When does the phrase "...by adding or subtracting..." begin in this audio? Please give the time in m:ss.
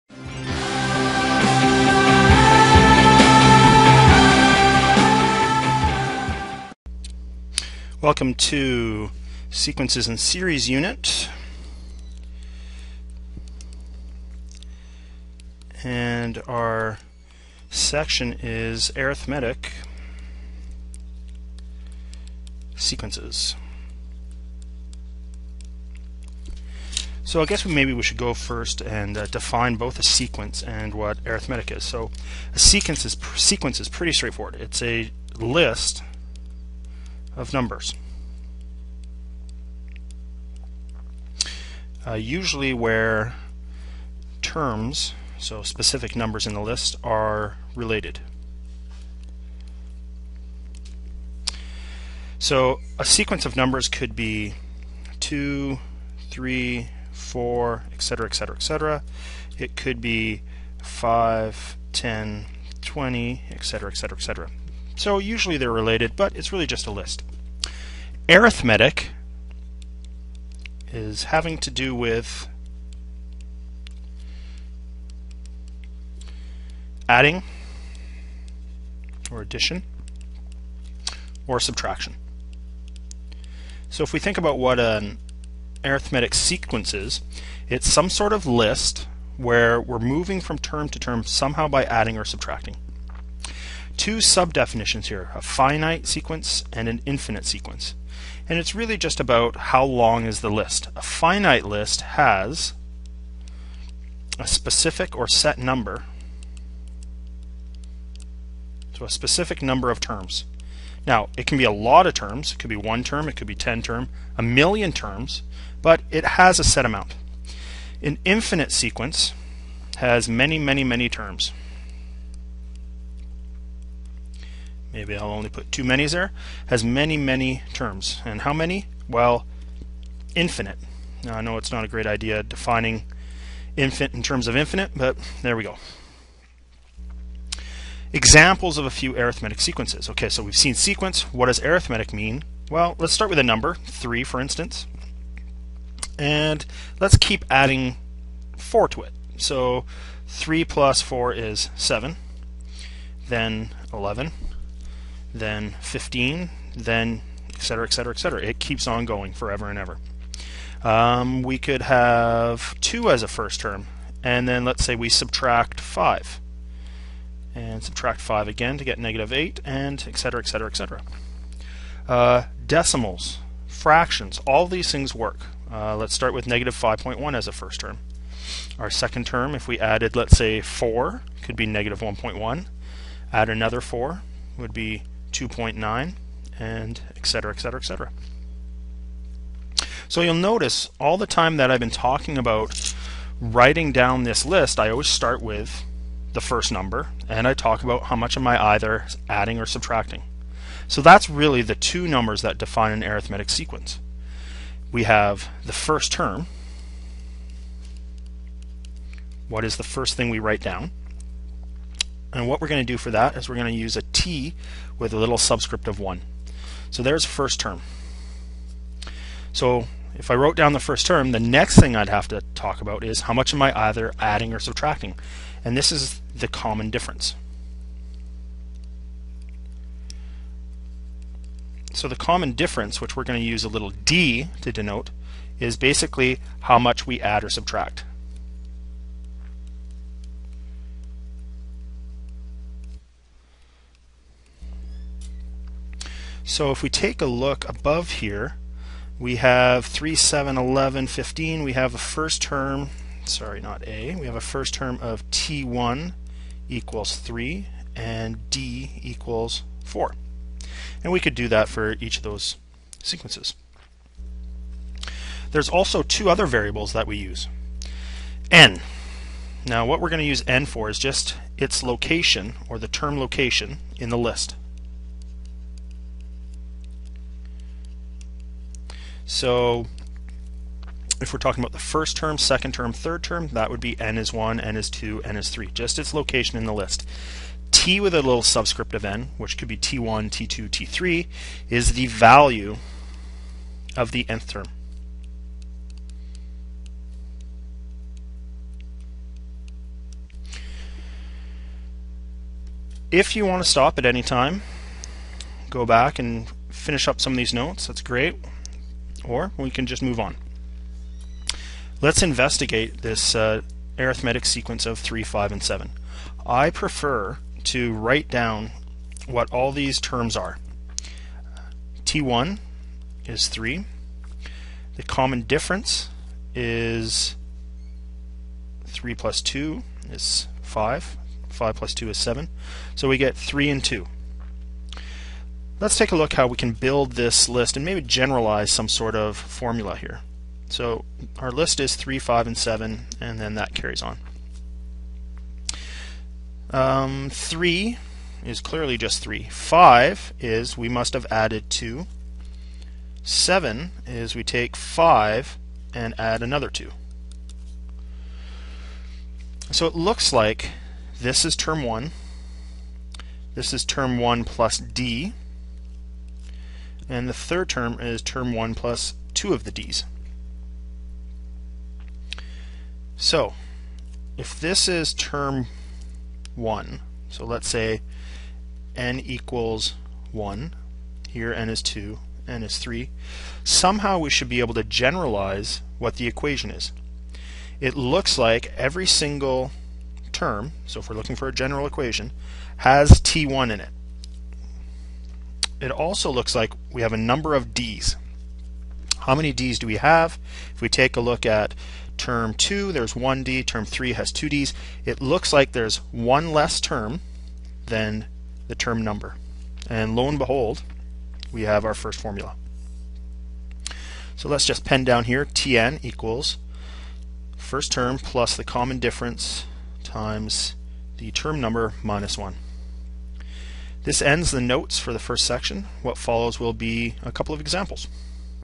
1:31.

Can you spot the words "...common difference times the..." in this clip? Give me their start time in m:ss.
6:58.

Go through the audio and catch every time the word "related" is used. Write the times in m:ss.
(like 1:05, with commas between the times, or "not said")
0:47, 1:05.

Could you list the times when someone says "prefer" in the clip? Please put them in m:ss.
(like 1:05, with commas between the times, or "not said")
5:16.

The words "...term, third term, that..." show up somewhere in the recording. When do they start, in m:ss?
4:42.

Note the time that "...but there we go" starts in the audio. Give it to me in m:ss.
2:14.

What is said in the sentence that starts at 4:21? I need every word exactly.
And we could do that for each of those sequences.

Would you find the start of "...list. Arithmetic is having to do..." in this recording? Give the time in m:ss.
1:06.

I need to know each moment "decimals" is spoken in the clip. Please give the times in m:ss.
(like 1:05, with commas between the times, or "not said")
2:52.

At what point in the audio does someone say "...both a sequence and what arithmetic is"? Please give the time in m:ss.
0:29.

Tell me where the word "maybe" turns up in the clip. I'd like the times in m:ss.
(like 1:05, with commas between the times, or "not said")
0:27, 2:04, 5:37.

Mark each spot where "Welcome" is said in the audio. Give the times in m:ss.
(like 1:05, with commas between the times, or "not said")
0:08.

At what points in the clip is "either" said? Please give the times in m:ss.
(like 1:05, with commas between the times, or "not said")
3:18, 3:43.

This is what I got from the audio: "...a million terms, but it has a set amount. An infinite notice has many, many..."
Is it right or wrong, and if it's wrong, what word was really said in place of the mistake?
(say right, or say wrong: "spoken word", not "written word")
wrong: "sequence", not "notice".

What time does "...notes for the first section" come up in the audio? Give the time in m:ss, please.
7:04.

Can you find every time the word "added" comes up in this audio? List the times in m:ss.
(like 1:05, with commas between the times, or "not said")
2:59, 5:51.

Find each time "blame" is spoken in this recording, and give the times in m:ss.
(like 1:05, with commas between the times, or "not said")
not said.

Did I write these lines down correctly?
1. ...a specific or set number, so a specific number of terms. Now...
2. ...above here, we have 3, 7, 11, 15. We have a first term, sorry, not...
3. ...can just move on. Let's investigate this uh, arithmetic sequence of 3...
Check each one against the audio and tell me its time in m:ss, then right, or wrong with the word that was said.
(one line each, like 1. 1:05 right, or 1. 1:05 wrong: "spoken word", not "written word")
1. 1:44 right
2. 4:07 right
3. 5:09 right.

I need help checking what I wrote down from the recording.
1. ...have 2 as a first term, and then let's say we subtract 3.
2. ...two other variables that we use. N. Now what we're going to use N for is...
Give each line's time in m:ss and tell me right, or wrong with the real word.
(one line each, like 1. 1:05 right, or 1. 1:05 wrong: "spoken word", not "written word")
1. 2:41 wrong: "5", not "3"
2. 4:26 right.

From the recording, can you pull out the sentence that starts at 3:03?
Add another 4 would be 2.9, and etc., etc., etc.